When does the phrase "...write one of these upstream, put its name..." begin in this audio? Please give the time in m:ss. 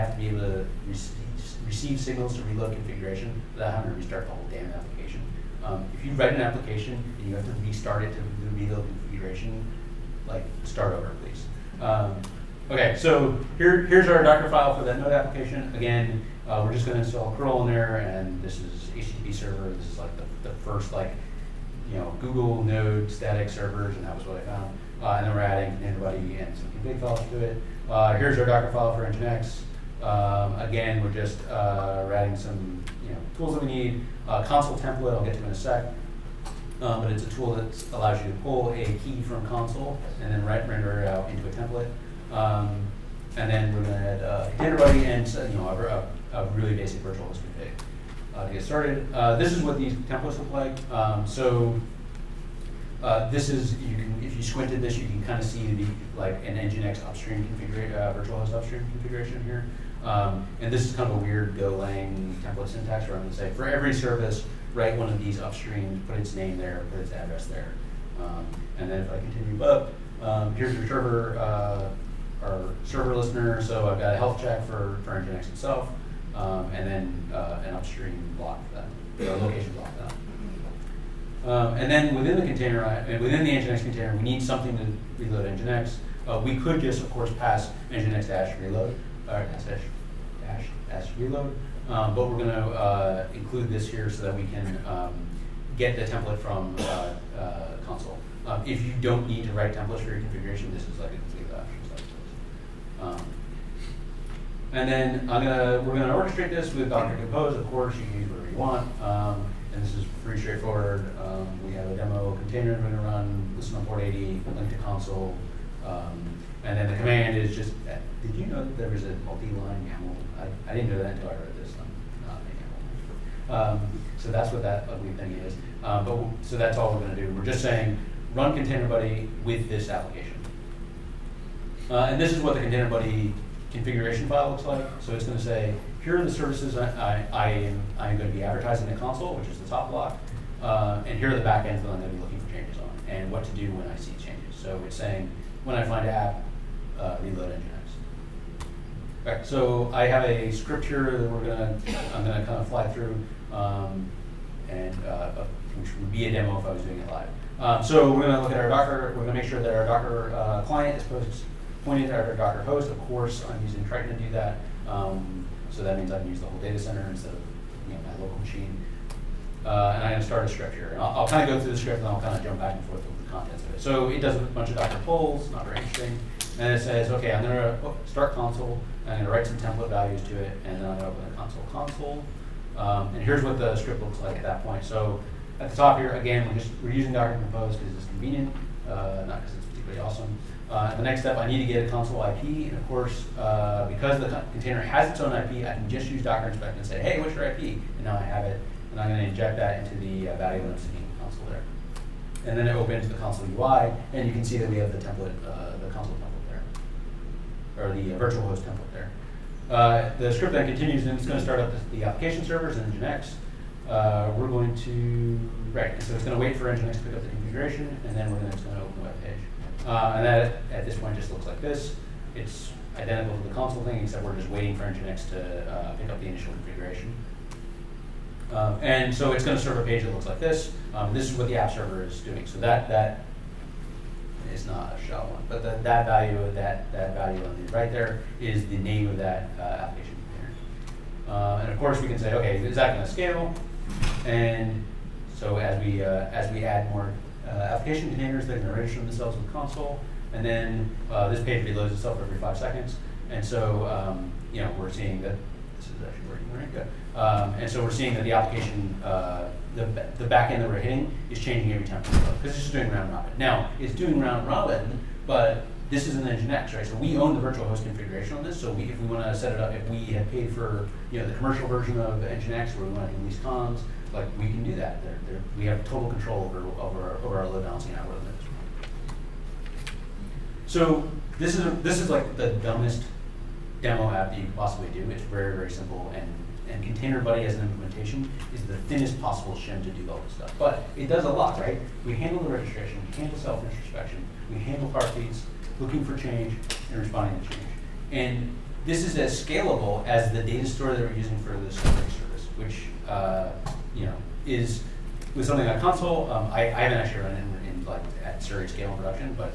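1:04.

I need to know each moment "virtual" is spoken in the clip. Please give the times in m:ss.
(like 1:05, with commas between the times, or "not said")
0:47, 0:58, 3:28, 4:27.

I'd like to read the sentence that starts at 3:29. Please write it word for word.
Uh, the script then continues, and it's going to start up the, the application servers and Nginx.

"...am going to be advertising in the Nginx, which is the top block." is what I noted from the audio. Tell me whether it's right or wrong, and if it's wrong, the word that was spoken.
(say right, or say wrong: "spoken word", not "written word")
wrong: "Consul", not "Nginx".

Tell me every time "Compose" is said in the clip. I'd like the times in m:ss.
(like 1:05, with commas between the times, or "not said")
1:47, 3:07.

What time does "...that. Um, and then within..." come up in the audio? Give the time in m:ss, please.
1:20.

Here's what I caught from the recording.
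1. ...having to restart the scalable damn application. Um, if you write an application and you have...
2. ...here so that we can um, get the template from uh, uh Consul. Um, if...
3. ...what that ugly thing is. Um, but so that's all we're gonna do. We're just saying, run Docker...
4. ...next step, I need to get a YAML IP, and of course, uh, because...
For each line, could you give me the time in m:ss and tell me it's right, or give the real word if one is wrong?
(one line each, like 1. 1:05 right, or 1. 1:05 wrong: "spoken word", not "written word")
1. 0:03 wrong: "whole", not "scalable"
2. 1:33 right
3. 2:04 wrong: "Containerbuddy", not "Docker"
4. 3:11 wrong: "Consul", not "YAML".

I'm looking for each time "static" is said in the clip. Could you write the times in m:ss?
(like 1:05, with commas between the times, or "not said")
0:23.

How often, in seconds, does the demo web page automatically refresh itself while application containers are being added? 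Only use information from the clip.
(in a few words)
5.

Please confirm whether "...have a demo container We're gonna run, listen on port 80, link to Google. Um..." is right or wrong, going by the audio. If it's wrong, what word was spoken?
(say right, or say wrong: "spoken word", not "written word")
wrong: "Consul", not "Google".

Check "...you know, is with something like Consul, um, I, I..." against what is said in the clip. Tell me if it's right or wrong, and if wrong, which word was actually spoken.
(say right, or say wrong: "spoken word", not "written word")
right.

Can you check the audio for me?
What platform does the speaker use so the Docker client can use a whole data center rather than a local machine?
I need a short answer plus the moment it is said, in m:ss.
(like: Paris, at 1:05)
Triton, at 2:43.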